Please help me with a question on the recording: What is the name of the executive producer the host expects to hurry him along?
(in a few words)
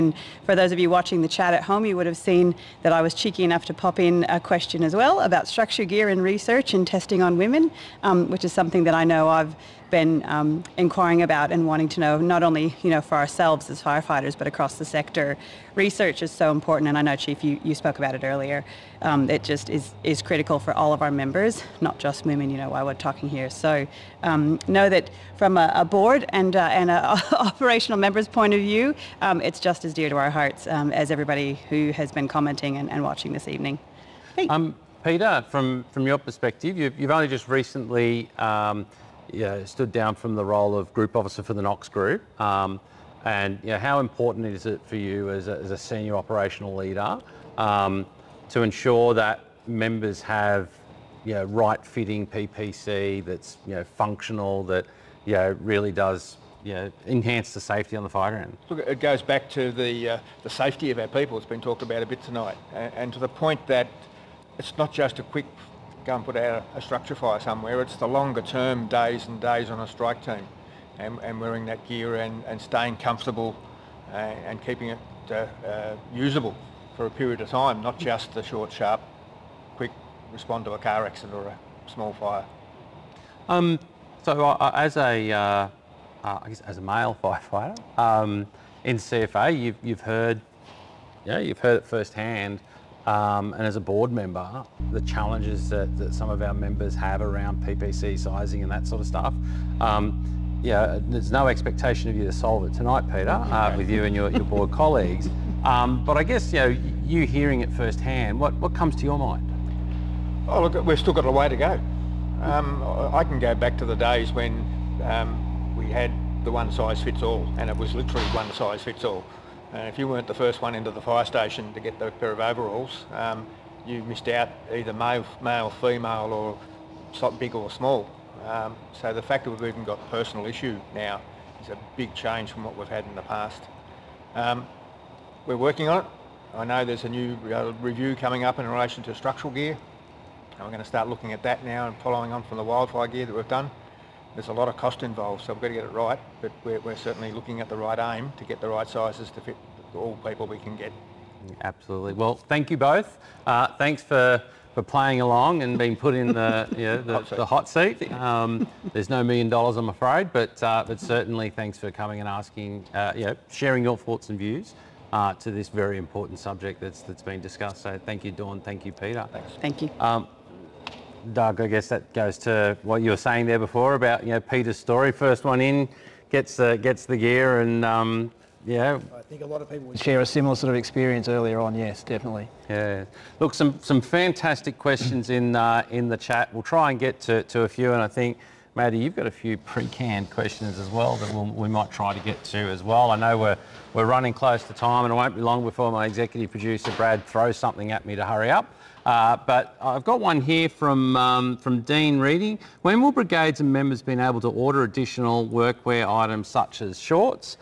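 Brad.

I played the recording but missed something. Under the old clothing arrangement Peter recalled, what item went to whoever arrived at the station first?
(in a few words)
overalls.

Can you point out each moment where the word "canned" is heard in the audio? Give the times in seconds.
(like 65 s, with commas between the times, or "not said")
189 s.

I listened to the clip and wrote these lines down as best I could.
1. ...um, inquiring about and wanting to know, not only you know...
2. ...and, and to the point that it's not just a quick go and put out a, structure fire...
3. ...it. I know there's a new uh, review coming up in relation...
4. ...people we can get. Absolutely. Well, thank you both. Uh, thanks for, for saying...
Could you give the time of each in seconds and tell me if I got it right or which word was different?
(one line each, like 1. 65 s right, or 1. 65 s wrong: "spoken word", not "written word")
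1. 10 s right
2. 62 s right
3. 136 s right
4. 150 s wrong: "playing", not "saying".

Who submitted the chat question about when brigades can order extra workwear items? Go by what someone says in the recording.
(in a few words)
Dean Reading.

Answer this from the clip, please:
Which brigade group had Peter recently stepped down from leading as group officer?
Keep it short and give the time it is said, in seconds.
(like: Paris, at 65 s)
Knox Group, at 41 s.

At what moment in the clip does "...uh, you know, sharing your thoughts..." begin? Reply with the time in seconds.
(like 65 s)
162 s.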